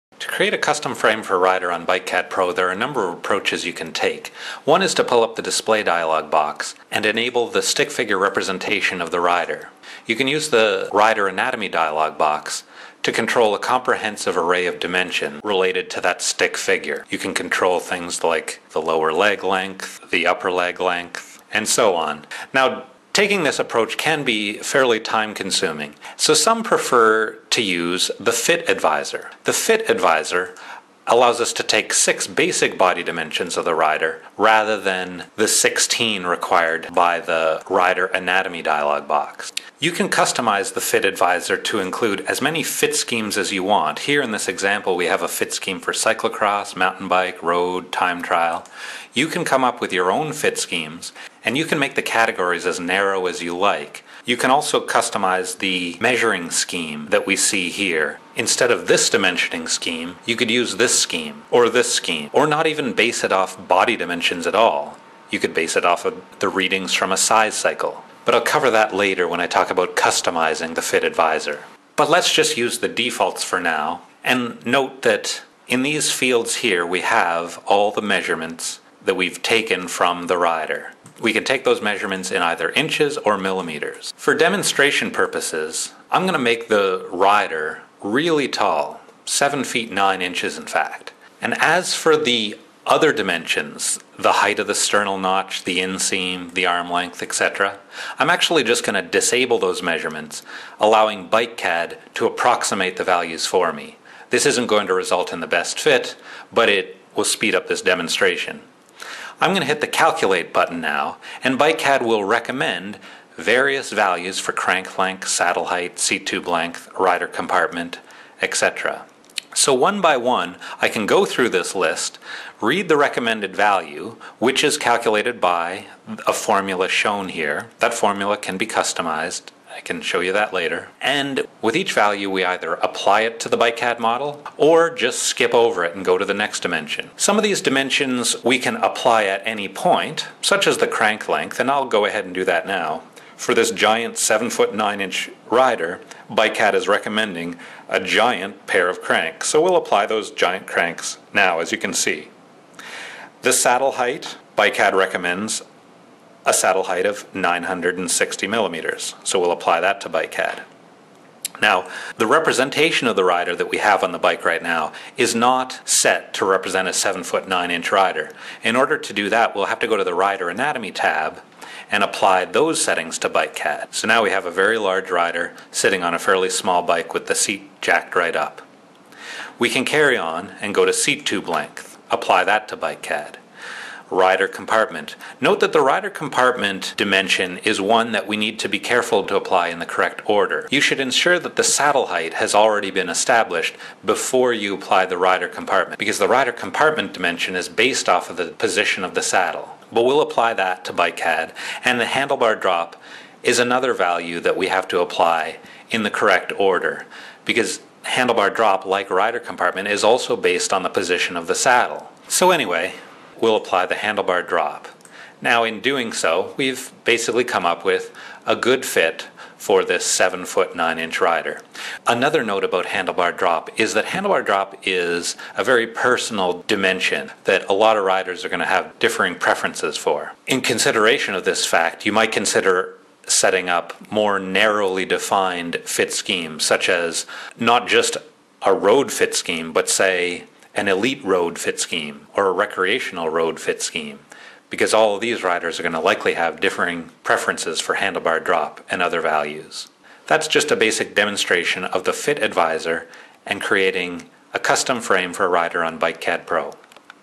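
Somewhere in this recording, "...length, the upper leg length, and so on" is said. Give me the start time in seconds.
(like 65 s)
19 s.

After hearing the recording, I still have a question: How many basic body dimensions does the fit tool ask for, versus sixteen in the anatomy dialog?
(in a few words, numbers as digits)
6.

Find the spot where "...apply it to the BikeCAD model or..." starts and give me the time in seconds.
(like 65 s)
132 s.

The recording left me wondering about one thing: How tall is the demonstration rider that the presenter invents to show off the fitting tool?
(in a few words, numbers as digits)
7 feet 9 inches.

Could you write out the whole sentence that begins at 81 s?
We can take those measurements in either inches or millimeters.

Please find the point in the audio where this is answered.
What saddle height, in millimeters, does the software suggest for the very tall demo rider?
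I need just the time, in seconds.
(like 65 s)
157 s.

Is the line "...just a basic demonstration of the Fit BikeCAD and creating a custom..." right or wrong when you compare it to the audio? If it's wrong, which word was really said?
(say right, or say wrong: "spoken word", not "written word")
wrong: "Advisor", not "BikeCAD".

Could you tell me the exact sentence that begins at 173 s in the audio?
So now we have a very large rider sitting on a fairly small bike with the seat jacked right up.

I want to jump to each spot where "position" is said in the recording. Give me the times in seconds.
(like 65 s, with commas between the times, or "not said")
198 s, 210 s.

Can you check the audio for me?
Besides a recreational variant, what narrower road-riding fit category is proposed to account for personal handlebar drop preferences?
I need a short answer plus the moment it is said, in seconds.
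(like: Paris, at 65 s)
elite road, at 240 s.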